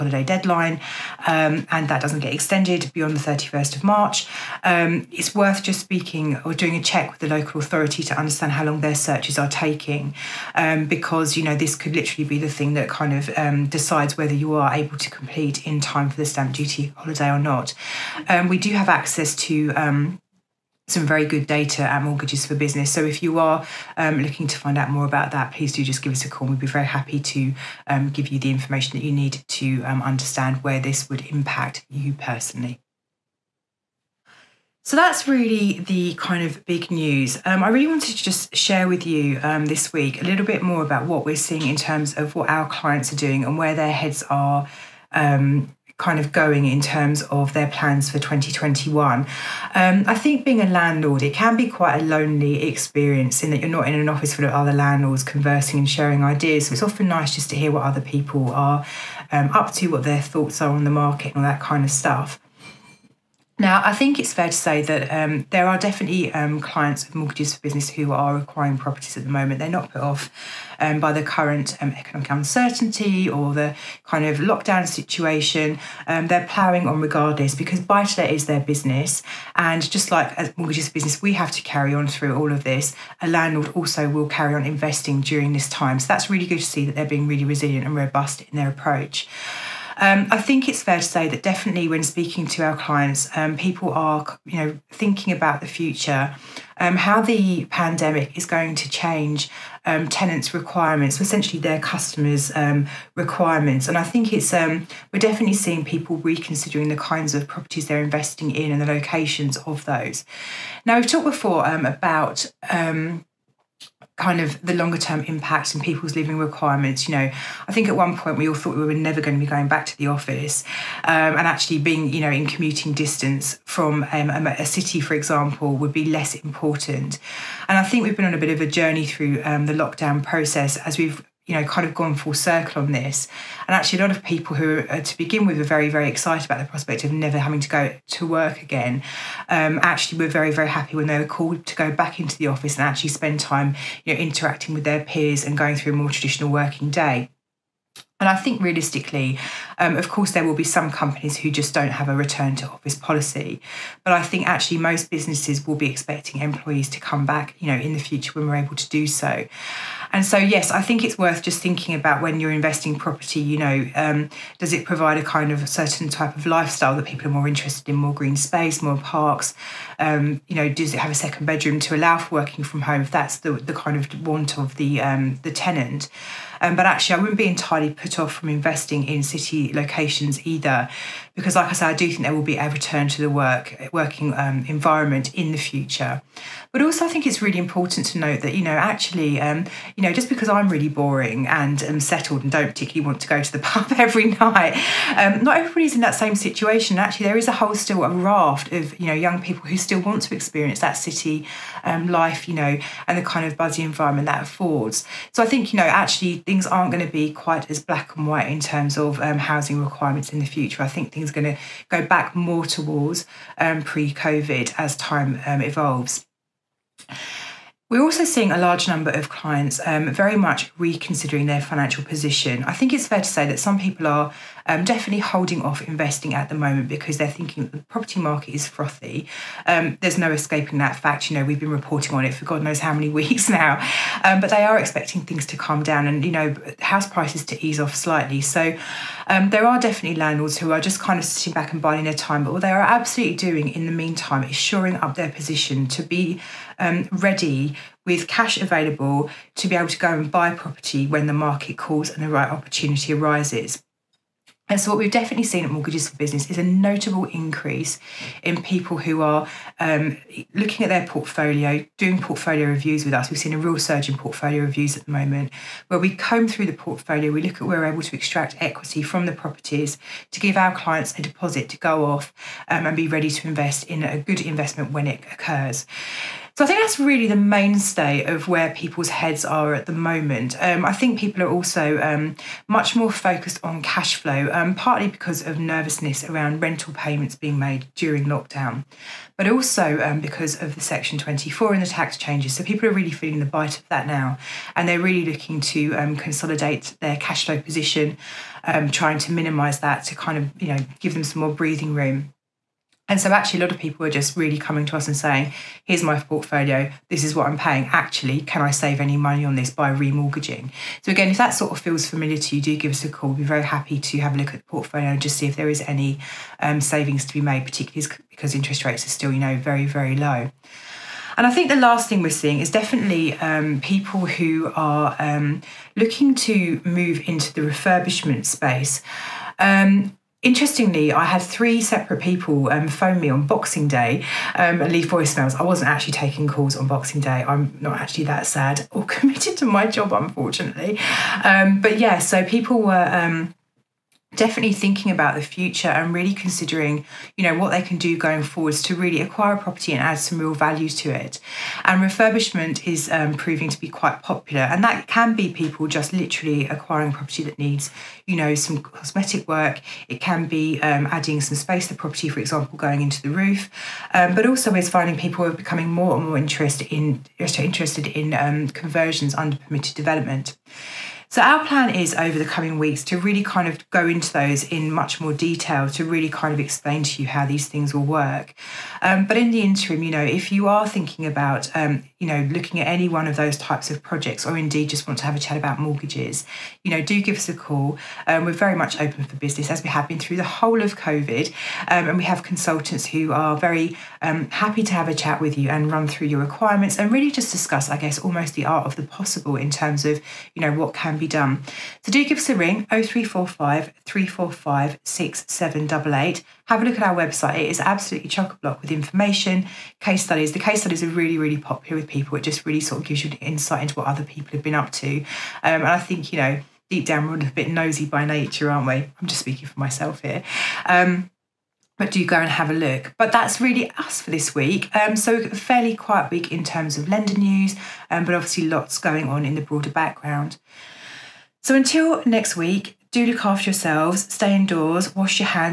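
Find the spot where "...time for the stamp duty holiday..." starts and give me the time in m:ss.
0:15.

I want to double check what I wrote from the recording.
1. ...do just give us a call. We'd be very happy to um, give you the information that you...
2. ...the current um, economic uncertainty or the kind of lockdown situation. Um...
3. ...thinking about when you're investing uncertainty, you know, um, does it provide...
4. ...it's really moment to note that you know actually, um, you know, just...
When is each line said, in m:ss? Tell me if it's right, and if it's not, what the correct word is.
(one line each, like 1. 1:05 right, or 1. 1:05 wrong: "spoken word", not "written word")
1. 0:25 right
2. 1:11 right
3. 2:41 wrong: "property", not "uncertainty"
4. 3:07 wrong: "important", not "moment".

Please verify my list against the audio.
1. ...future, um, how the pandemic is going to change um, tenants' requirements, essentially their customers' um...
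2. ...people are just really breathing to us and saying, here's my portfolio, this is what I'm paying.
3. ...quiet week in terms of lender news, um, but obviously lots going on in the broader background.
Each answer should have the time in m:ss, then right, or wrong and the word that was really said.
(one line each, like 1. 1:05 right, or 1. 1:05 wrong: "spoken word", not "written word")
1. 1:35 right
2. 5:03 wrong: "coming", not "breathing"
3. 7:05 right.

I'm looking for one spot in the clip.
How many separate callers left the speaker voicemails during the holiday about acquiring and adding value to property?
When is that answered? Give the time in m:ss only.
5:31.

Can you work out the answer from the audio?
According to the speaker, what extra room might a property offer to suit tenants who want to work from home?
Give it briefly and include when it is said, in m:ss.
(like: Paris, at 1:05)
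Second bedroom, at 2:51.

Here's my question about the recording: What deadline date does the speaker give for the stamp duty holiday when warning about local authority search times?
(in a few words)
31st of March.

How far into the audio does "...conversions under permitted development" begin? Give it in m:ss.
6:08.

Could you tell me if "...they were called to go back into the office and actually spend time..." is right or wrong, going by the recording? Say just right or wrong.
right.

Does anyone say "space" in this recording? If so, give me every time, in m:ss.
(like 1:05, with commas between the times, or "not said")
2:48, 5:28, 6:01.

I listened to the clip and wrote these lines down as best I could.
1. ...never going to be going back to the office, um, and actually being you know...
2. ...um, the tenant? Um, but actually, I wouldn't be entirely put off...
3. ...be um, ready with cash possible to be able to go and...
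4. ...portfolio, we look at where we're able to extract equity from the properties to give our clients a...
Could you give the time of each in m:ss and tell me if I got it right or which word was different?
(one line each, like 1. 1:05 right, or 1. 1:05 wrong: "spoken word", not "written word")
1. 1:58 right
2. 2:55 right
3. 4:06 wrong: "available", not "possible"
4. 4:26 right.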